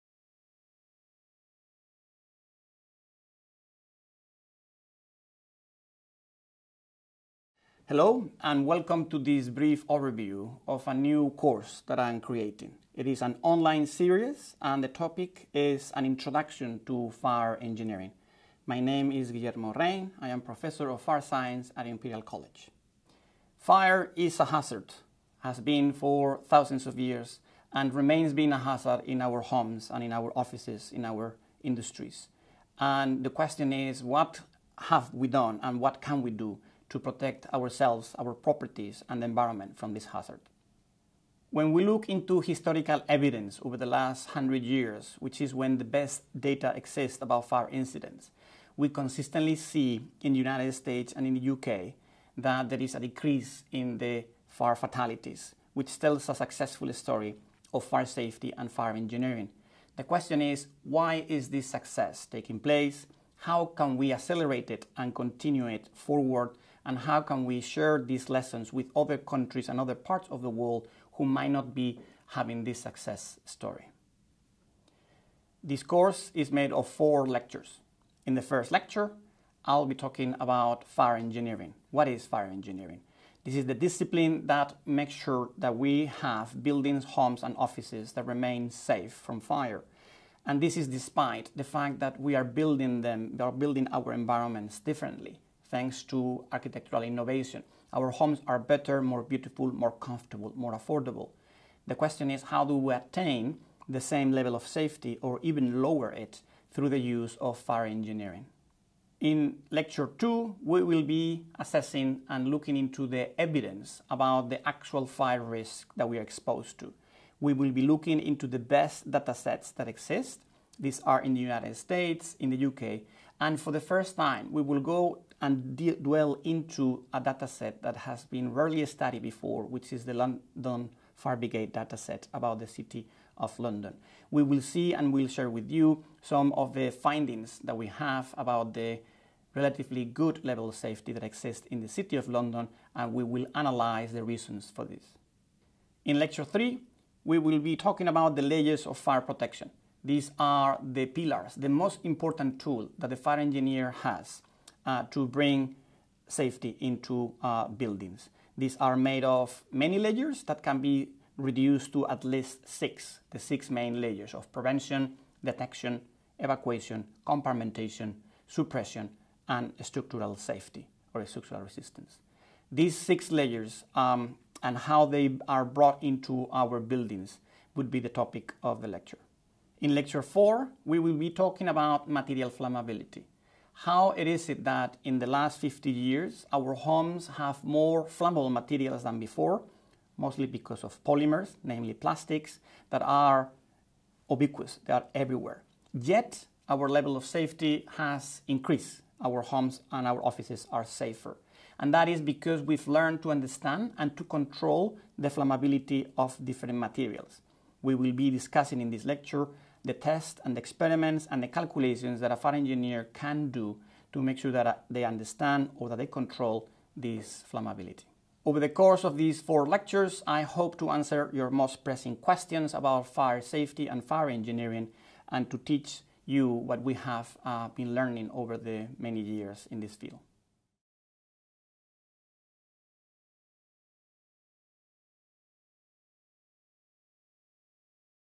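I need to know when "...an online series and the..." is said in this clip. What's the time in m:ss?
0:13.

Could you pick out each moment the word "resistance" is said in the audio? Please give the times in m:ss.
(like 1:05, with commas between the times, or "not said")
2:51.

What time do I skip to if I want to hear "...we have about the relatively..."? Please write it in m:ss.
2:17.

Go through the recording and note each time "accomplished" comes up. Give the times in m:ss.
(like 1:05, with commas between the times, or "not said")
not said.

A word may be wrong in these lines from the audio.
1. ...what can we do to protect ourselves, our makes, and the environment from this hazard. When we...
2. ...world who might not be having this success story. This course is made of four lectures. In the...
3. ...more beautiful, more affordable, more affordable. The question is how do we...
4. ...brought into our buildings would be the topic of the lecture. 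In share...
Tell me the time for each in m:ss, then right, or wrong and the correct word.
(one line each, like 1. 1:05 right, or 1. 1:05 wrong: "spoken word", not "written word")
1. 0:35 wrong: "properties", not "makes"
2. 1:10 right
3. 1:39 wrong: "comfortable", not "affordable"
4. 2:55 wrong: "lecture", not "share".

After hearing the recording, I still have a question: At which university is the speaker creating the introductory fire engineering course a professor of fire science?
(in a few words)
Imperial College.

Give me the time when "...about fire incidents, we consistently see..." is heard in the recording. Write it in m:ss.
0:47.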